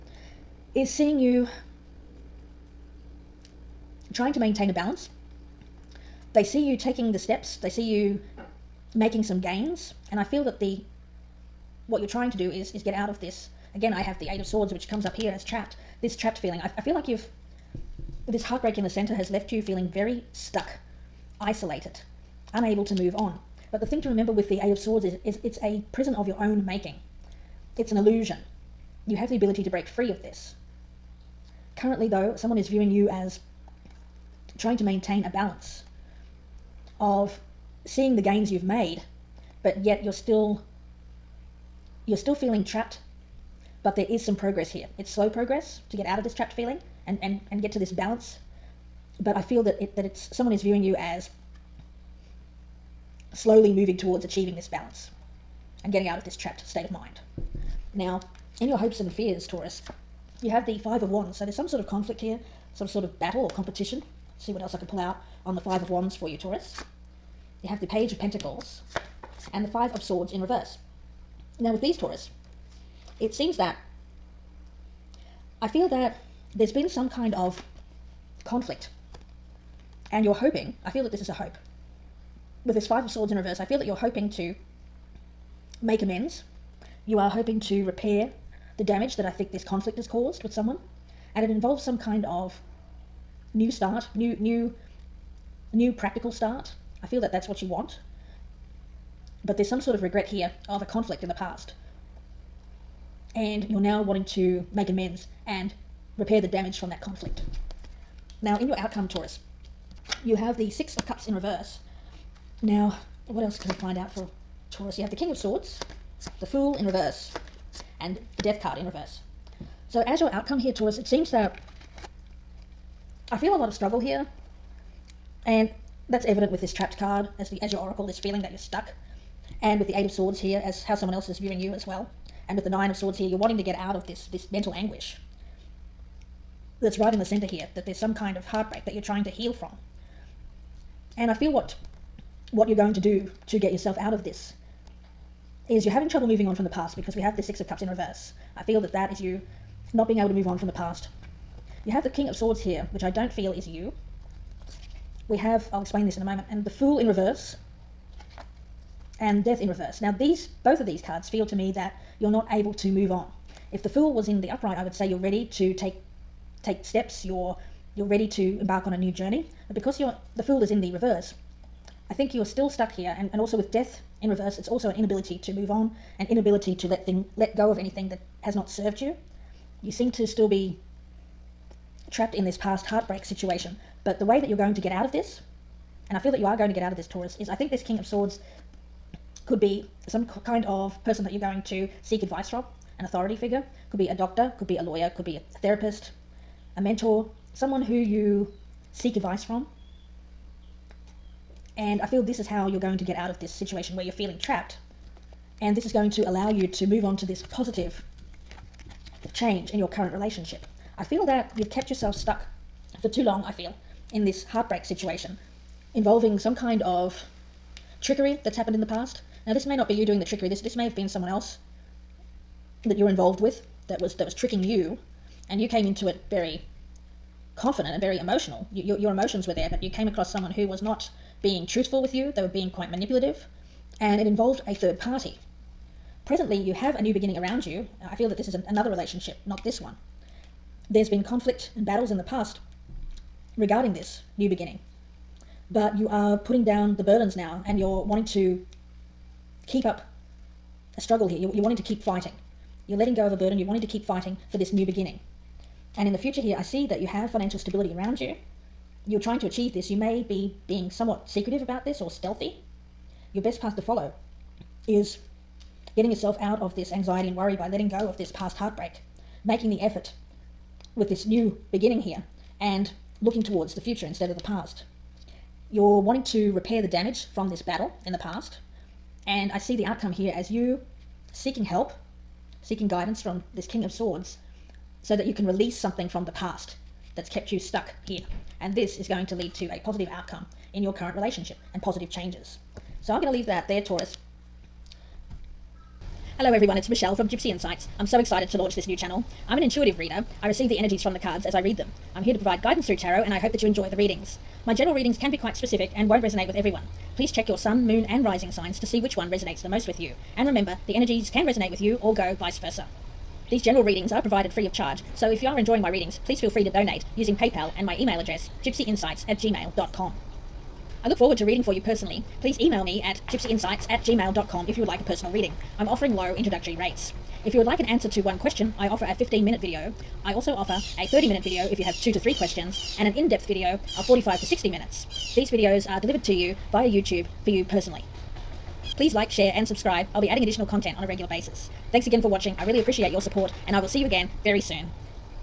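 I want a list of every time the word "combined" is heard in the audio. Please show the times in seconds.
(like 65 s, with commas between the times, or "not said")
not said.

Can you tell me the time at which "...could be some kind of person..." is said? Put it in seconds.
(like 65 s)
189 s.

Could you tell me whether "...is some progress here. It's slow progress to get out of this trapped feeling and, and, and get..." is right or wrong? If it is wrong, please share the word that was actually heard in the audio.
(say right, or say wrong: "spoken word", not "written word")
right.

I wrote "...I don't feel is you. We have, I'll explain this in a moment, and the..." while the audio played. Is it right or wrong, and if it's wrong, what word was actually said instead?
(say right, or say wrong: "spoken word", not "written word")
right.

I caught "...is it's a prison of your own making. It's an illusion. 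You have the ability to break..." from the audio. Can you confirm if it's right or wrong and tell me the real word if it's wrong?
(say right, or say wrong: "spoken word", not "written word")
right.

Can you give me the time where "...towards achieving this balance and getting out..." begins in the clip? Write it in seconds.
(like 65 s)
53 s.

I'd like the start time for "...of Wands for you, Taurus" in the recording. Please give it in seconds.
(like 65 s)
65 s.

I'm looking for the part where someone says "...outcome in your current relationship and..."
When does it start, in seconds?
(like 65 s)
290 s.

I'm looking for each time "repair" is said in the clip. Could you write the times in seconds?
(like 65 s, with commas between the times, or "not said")
87 s, 106 s, 276 s.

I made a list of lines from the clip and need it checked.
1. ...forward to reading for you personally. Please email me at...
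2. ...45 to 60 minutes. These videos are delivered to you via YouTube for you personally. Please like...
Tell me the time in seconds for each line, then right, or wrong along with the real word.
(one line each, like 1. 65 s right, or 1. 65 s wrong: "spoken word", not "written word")
1. 321 s right
2. 334 s right.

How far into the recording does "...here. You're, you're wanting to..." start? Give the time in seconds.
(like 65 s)
251 s.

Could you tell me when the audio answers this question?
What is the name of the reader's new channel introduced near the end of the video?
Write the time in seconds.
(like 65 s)
297 s.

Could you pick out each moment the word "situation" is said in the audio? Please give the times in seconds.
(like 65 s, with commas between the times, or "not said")
183 s, 203 s, 214 s.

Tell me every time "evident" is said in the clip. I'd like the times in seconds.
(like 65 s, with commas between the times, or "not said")
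126 s.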